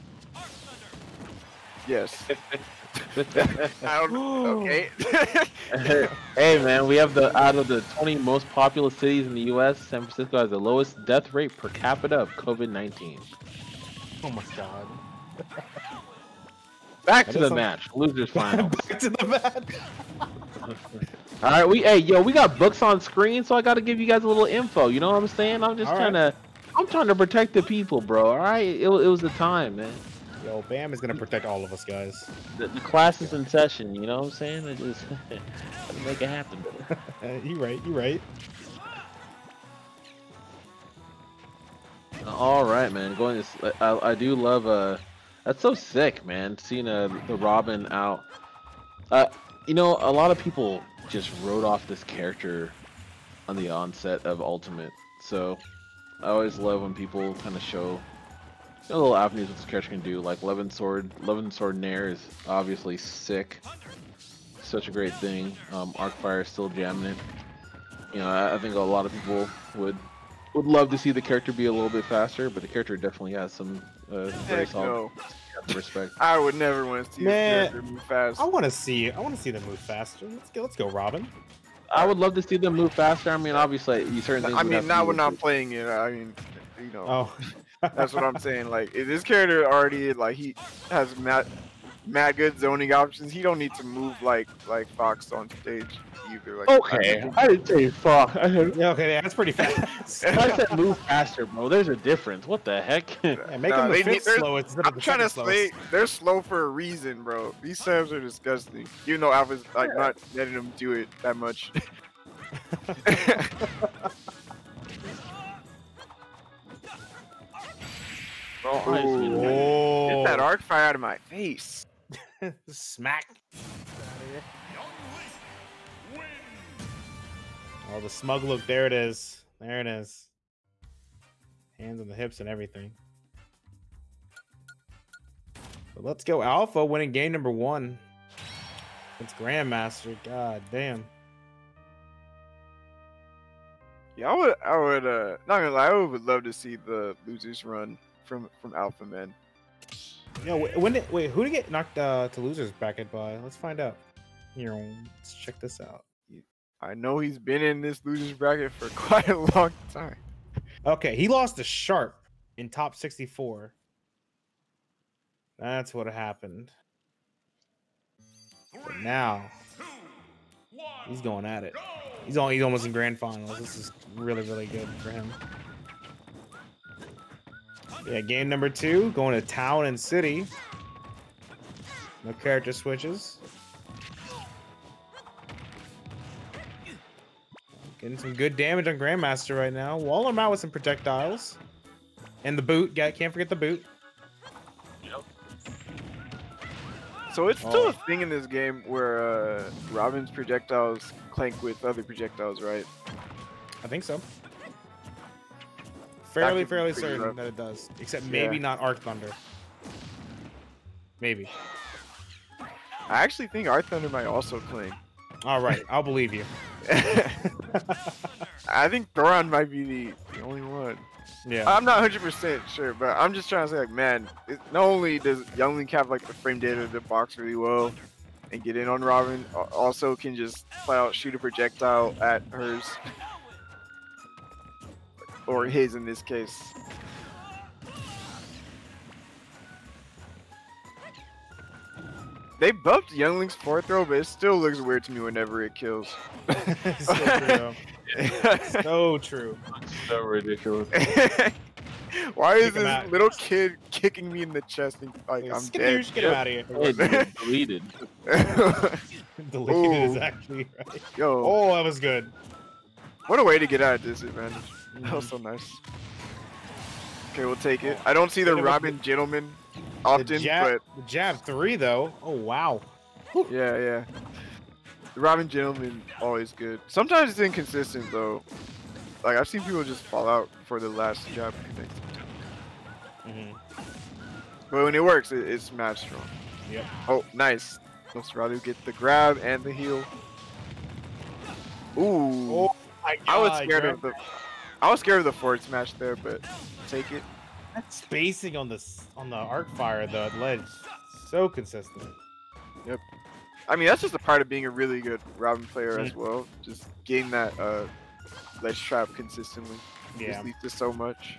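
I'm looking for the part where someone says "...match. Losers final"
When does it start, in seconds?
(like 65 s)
17 s.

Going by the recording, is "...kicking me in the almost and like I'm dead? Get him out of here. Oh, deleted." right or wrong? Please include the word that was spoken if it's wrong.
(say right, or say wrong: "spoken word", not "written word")
wrong: "chest", not "almost".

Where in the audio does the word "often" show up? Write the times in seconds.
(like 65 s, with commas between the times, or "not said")
270 s.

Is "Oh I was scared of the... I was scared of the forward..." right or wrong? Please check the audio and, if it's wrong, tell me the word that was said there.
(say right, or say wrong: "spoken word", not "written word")
right.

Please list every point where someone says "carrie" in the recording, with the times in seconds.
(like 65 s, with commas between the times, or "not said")
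not said.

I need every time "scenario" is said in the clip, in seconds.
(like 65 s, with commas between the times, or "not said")
not said.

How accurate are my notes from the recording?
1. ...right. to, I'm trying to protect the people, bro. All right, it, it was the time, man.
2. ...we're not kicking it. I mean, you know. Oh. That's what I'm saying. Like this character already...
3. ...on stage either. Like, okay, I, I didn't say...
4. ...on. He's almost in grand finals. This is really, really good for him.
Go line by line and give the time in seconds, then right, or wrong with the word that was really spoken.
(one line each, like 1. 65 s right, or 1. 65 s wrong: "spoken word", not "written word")
1. 26 s right
2. 85 s wrong: "playing", not "kicking"
3. 95 s right
4. 172 s right.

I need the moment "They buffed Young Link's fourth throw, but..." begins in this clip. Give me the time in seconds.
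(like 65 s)
242 s.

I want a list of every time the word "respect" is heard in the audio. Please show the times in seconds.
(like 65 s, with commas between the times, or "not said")
75 s.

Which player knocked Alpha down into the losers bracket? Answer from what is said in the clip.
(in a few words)
Sharp.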